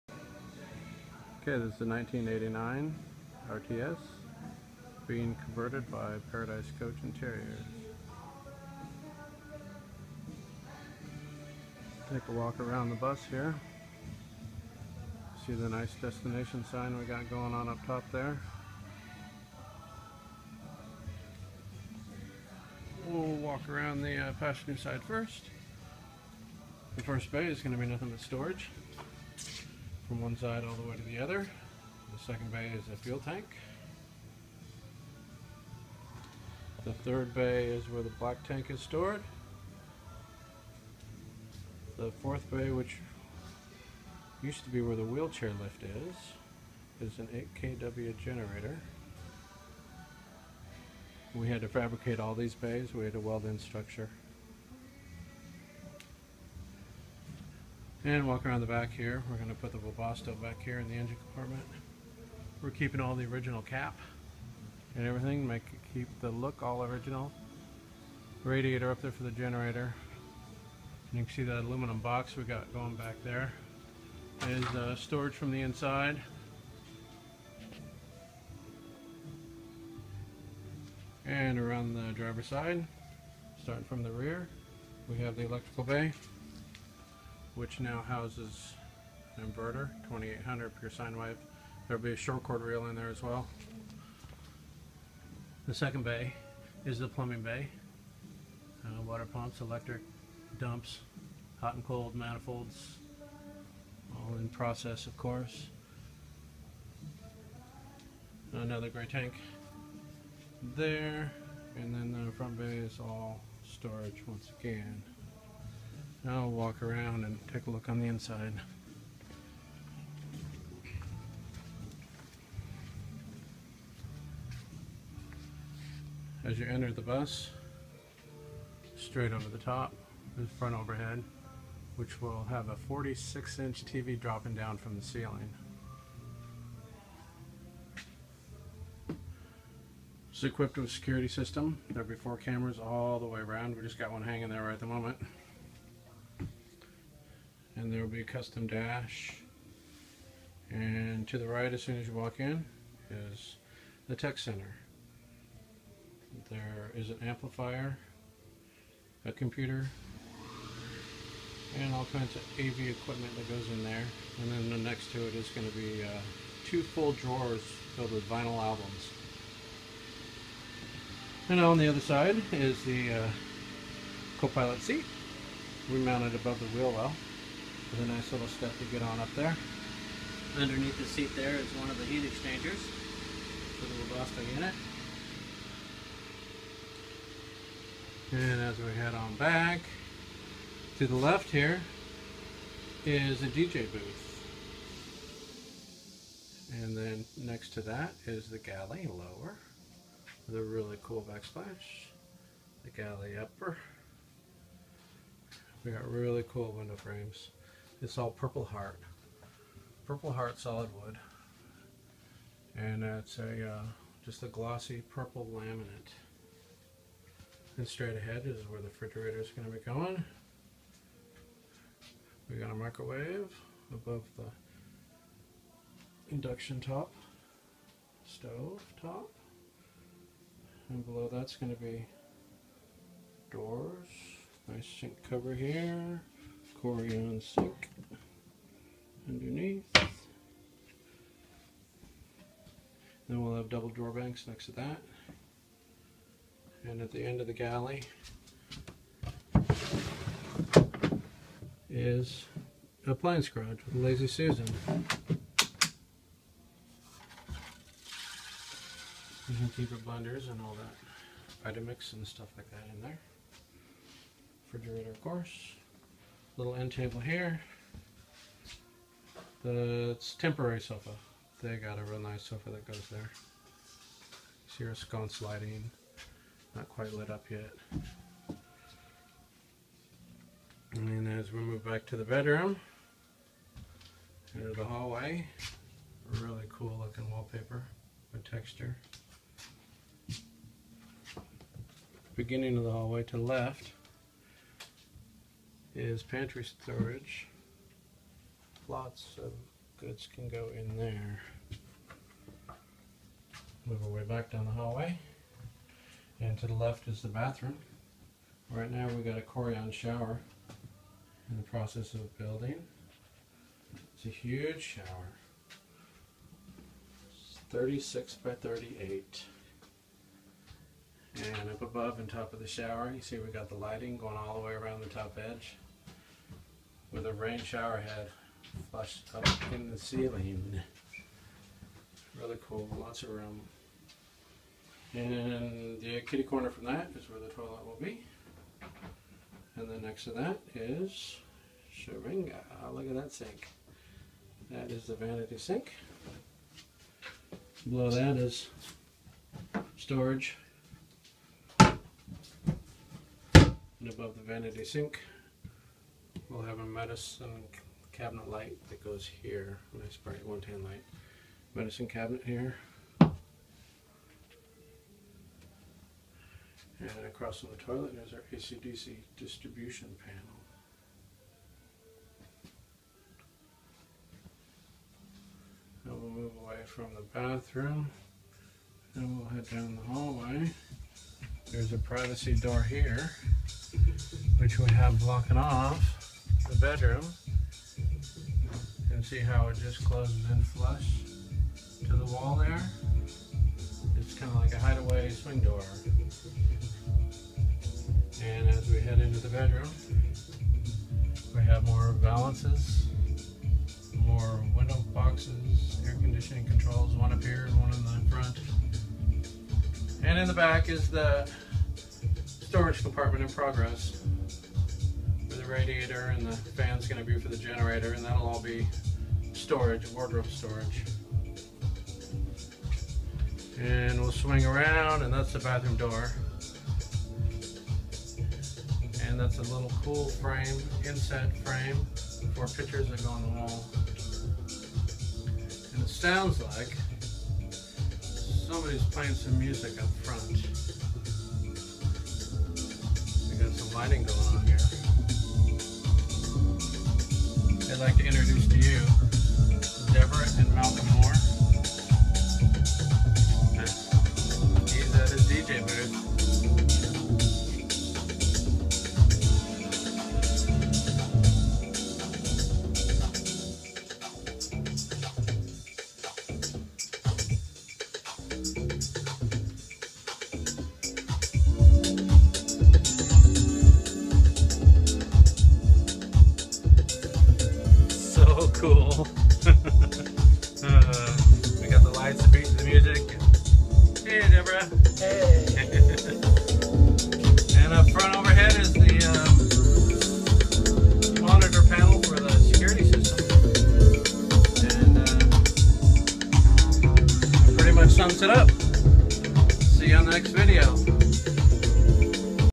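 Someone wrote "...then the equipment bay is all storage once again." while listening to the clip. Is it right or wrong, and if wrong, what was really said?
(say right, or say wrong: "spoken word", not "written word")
wrong: "front", not "equipment".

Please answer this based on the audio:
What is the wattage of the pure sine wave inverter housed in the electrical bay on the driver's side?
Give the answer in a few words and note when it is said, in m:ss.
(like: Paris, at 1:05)
2800, at 1:30.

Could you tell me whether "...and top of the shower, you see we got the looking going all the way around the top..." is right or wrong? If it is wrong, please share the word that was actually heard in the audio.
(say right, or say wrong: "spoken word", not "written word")
wrong: "lighting", not "looking".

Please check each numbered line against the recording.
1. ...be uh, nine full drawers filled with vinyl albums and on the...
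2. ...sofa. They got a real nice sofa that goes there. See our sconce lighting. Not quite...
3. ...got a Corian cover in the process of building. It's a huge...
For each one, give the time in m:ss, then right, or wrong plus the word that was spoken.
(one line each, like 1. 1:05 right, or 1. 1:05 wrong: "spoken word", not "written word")
1. 2:45 wrong: "two", not "nine"
2. 4:30 right
3. 5:09 wrong: "shower", not "cover".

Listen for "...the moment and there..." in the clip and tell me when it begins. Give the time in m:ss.
2:24.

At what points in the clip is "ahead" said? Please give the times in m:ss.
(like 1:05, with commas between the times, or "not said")
3:38.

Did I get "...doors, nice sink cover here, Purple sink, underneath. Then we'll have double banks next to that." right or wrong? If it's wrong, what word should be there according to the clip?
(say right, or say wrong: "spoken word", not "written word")
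wrong: "Corian", not "Purple".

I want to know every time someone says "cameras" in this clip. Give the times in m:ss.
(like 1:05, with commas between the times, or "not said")
2:22.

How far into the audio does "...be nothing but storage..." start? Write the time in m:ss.
0:27.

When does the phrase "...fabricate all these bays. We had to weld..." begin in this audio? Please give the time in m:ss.
0:51.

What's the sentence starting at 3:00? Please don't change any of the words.
Underneath the seat there is one of the heat exchangers for the Webasto unit.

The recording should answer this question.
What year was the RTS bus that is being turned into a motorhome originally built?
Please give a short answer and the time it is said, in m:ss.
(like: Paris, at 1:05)
1989, at 0:01.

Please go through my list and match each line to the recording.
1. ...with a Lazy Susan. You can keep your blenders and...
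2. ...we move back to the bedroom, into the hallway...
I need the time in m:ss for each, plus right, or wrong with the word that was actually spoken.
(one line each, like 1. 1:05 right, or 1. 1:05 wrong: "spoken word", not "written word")
1. 4:13 right
2. 4:41 right.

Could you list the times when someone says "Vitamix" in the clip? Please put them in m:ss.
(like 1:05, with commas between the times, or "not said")
4:21.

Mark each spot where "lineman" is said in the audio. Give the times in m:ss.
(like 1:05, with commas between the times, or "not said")
not said.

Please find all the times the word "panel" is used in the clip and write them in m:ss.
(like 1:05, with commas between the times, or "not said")
6:10.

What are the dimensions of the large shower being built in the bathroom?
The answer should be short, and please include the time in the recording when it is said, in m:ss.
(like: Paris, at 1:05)
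36 by 38, at 5:17.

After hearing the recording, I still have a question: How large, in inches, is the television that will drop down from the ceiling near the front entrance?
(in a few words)
46 inch.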